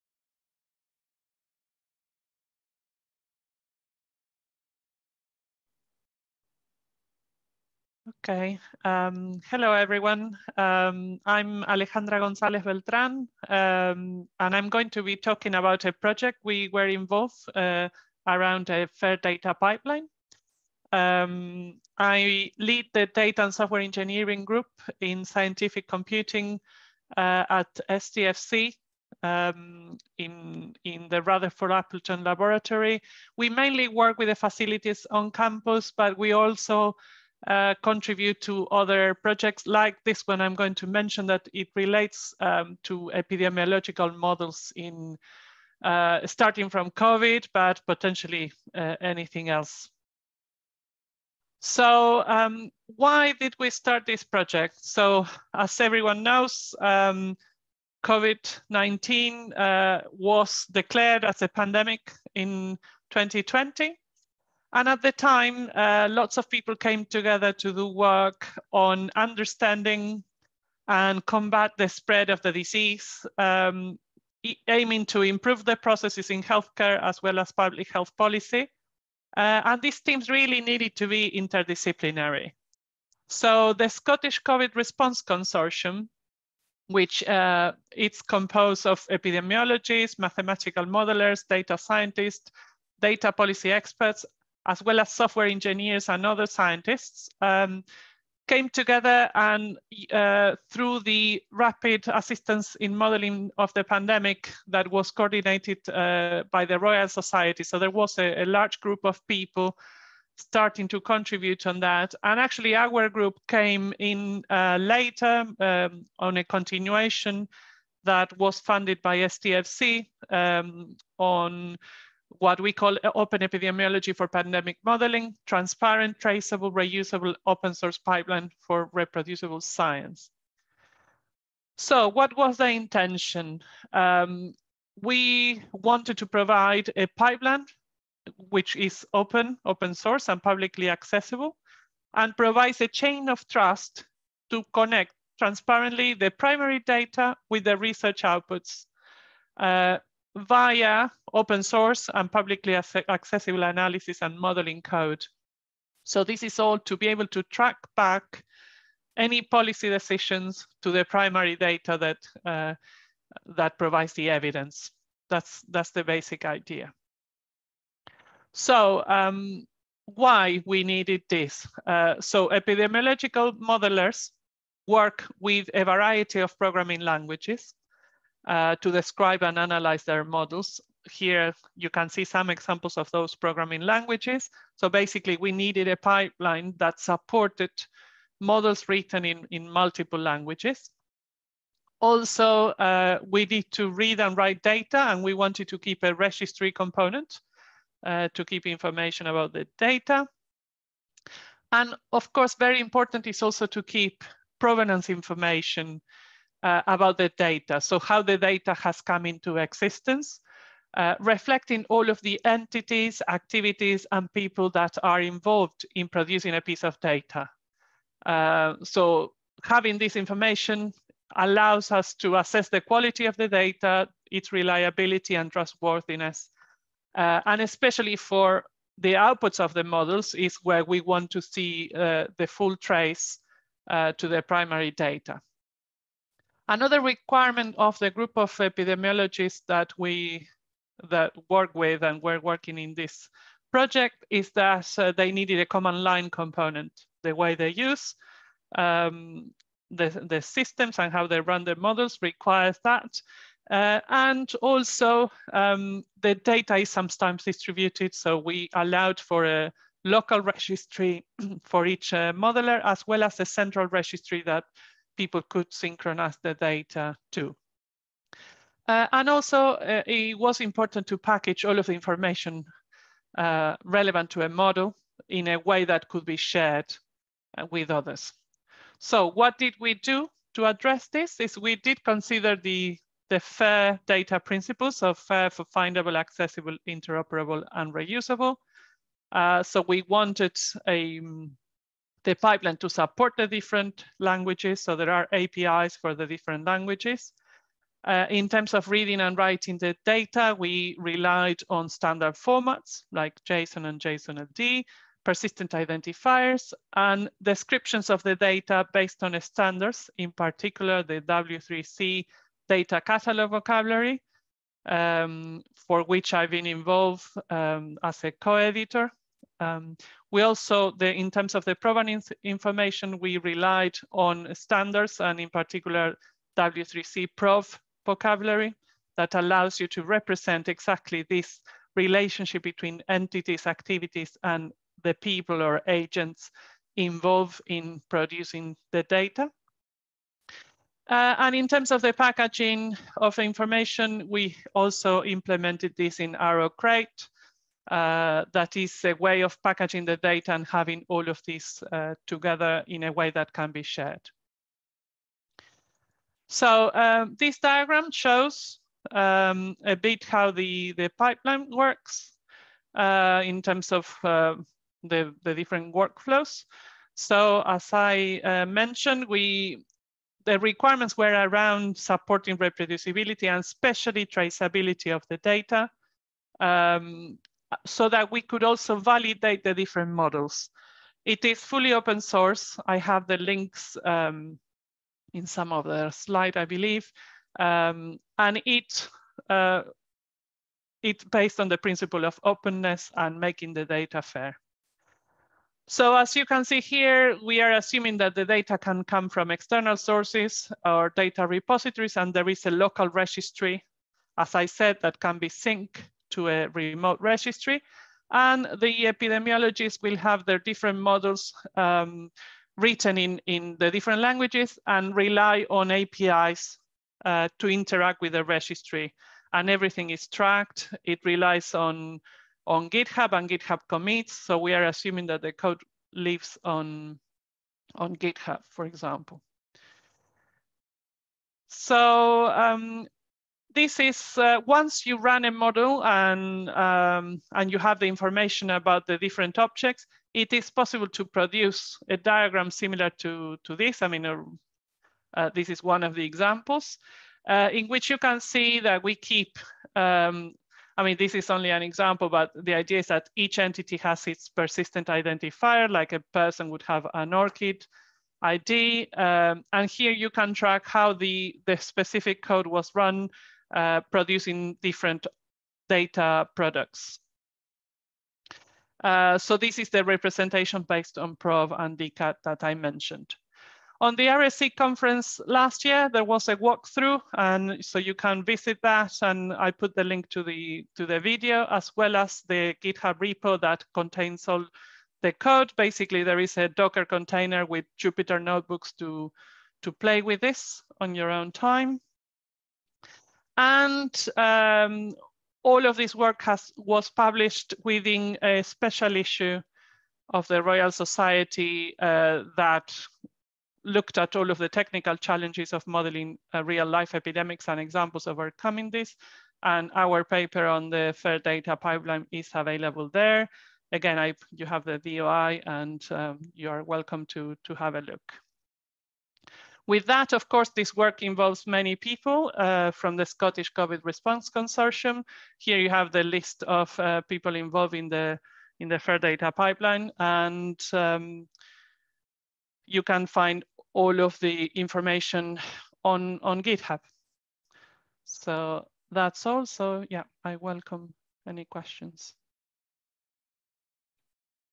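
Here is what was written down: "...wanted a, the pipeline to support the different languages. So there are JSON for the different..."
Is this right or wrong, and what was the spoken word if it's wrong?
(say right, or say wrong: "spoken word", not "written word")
wrong: "APIs", not "JSON".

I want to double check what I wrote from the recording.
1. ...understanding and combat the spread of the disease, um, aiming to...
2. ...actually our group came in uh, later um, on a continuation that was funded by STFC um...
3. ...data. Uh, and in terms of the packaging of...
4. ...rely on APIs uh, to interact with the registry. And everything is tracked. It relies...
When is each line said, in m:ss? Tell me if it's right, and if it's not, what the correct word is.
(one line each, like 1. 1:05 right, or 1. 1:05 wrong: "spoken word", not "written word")
1. 1:09 right
2. 1:52 right
3. 5:39 right
4. 6:55 right.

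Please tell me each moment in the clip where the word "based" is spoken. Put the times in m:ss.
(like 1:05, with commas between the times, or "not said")
5:08, 6:31, 7:50.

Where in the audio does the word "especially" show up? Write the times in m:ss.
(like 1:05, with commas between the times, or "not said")
3:47, 6:13.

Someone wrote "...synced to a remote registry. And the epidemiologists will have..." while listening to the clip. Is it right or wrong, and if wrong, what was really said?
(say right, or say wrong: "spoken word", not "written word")
right.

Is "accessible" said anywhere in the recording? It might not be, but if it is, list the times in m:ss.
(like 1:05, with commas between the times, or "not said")
2:20, 2:32, 4:46.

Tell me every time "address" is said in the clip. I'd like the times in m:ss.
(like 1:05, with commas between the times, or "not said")
4:40.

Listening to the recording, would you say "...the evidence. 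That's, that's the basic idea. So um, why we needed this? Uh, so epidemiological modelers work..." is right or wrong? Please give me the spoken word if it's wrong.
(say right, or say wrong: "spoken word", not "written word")
right.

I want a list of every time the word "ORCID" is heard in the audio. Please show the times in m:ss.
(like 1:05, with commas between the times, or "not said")
7:37.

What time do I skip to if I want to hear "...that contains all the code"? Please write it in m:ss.
8:03.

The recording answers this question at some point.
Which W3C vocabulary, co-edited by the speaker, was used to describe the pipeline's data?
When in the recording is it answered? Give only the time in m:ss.
5:12.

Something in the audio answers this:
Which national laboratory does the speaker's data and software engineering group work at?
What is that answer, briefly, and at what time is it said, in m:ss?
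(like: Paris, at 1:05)
Rutherford Appleton Laboratory, at 0:31.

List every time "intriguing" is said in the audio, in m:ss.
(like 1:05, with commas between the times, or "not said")
not said.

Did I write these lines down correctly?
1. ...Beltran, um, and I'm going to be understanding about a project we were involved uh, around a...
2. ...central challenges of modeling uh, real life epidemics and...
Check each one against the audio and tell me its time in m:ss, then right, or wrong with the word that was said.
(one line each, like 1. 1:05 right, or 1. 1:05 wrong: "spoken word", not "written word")
1. 0:12 wrong: "talking", not "understanding"
2. 8:24 wrong: "technical", not "central".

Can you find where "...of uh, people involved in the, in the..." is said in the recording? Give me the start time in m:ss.
8:46.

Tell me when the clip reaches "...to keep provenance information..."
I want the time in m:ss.
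3:23.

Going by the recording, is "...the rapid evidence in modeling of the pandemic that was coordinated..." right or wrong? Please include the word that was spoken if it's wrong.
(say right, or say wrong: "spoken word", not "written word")
wrong: "assistance", not "evidence".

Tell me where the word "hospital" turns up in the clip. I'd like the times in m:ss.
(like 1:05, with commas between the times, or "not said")
not said.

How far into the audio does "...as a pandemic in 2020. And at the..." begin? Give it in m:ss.
1:01.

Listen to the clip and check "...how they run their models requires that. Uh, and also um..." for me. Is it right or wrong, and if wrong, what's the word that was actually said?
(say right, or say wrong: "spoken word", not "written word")
right.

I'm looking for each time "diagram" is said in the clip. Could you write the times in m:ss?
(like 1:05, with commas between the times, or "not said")
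5:57, 7:22.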